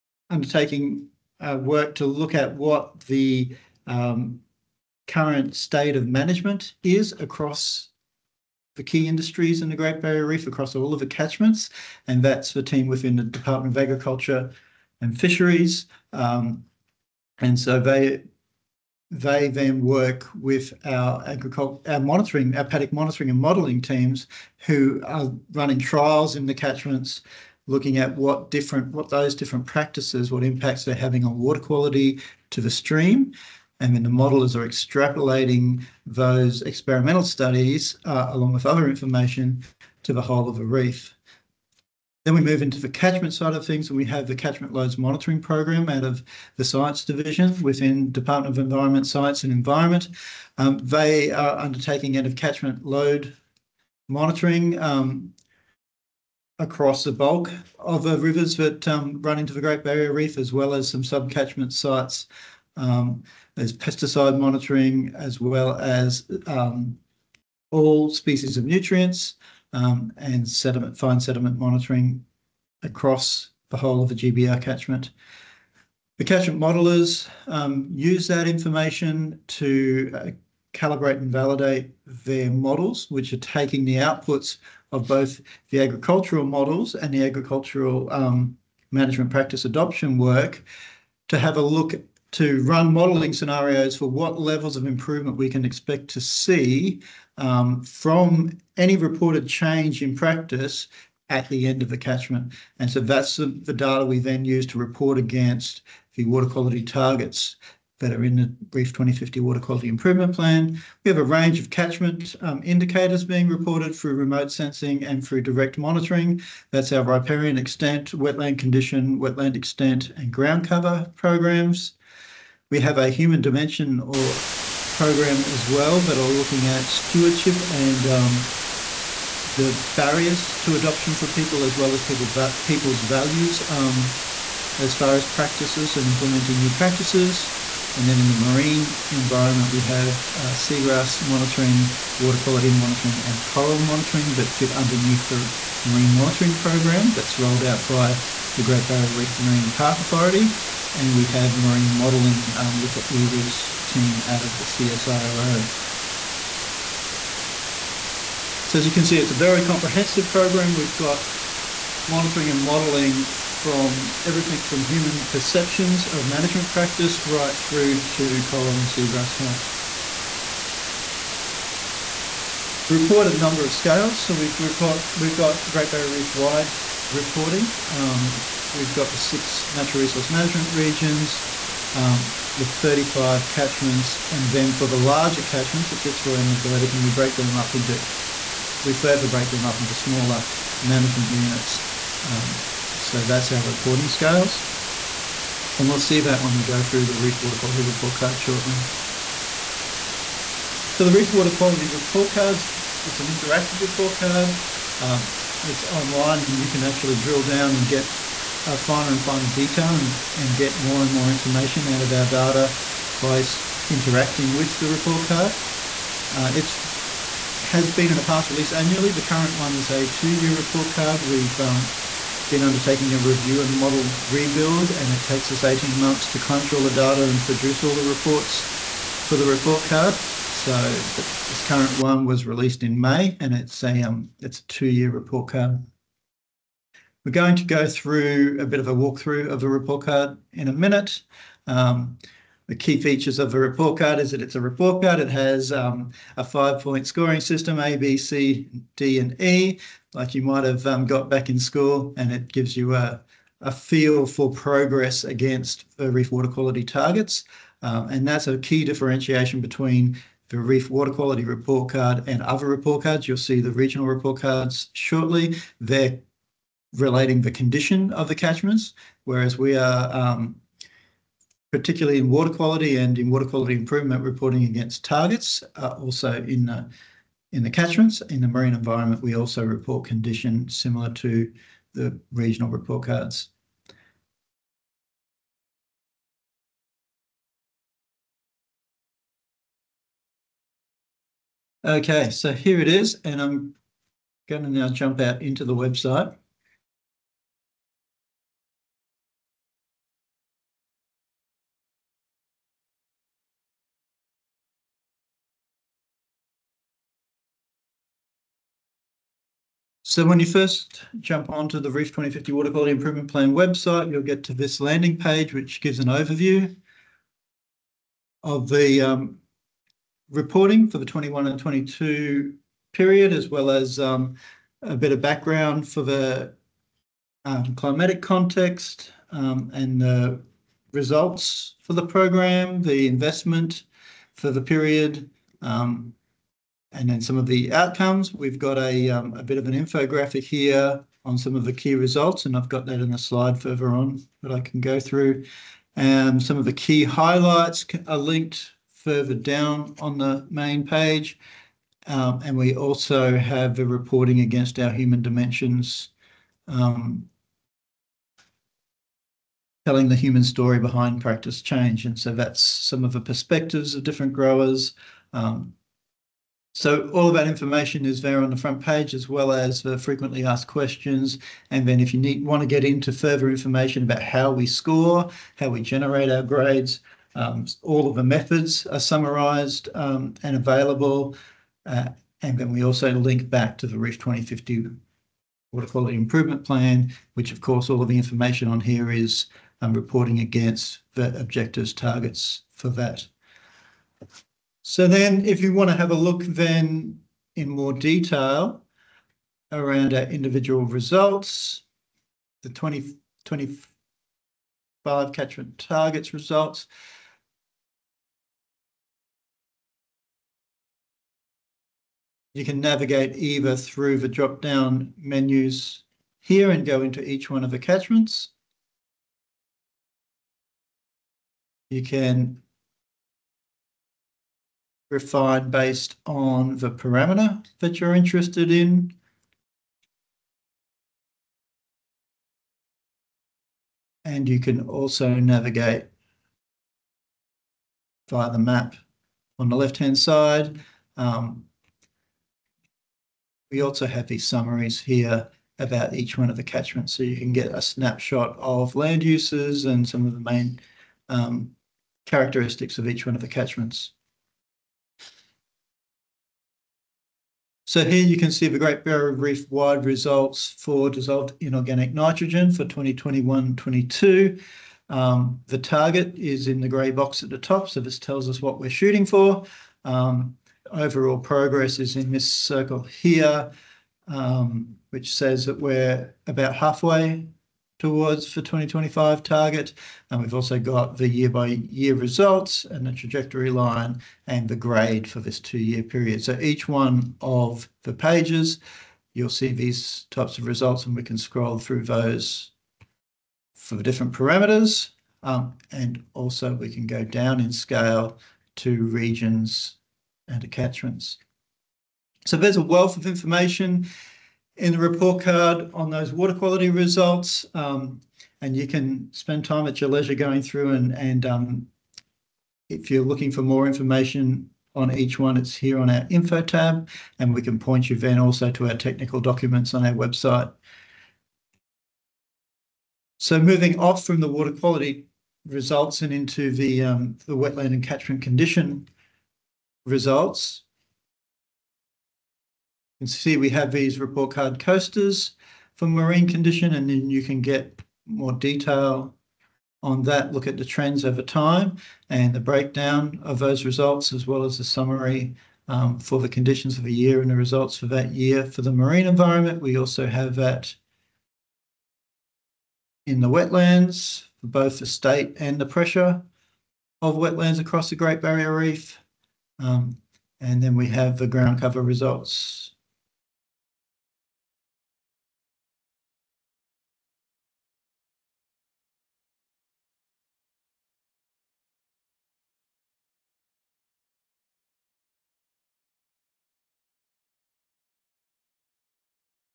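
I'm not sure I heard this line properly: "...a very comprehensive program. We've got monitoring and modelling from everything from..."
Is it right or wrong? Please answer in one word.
right.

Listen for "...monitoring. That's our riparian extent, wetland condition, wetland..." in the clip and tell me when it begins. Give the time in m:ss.
1:55.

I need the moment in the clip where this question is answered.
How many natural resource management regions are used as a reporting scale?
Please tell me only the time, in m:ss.
2:59.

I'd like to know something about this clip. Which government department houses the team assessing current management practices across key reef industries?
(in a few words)
Department of Agriculture and Fisheries.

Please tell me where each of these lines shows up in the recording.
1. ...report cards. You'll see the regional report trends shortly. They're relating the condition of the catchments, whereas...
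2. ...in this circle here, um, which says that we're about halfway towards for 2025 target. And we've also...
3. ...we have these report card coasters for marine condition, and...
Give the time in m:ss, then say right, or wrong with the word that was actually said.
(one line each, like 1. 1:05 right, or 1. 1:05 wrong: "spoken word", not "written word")
1. 4:22 wrong: "cards", not "trends"
2. 7:52 right
3. 8:53 right.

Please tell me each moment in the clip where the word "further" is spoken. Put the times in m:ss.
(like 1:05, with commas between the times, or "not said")
3:08, 5:43, 5:48, 6:13.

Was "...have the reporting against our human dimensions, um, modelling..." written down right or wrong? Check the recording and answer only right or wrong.
wrong.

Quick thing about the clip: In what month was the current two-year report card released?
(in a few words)
May.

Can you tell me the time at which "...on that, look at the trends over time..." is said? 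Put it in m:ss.
9:00.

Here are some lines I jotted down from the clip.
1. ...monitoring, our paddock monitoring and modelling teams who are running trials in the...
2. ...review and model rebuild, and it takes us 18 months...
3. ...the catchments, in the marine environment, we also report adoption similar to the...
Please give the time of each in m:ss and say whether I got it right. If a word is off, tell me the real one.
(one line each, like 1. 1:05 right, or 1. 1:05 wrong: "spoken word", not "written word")
1. 0:22 right
2. 3:43 right
3. 4:37 wrong: "condition", not "adoption".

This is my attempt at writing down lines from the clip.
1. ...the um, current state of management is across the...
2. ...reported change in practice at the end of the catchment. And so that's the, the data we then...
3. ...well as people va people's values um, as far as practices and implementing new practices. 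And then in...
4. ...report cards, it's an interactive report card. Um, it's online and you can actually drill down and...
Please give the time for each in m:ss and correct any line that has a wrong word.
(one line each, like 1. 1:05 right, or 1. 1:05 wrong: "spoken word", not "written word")
1. 0:03 right
2. 1:38 right
3. 2:11 right
4. 3:21 right.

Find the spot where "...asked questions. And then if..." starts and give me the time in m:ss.
6:10.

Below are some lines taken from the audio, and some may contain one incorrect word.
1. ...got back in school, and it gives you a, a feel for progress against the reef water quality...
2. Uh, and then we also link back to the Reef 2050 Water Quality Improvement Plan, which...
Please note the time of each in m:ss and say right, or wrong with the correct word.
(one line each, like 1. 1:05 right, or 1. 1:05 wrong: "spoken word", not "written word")
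1. 4:11 right
2. 6:21 right.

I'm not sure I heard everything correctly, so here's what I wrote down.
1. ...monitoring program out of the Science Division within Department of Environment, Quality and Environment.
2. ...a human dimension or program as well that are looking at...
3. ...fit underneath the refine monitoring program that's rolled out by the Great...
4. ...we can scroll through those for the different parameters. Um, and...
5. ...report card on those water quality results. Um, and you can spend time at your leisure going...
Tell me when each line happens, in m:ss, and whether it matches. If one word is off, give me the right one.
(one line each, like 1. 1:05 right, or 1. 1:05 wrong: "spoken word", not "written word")
1. 0:44 wrong: "Science", not "Quality"
2. 2:02 right
3. 2:24 wrong: "marine", not "refine"
4. 8:11 right
5. 8:24 right.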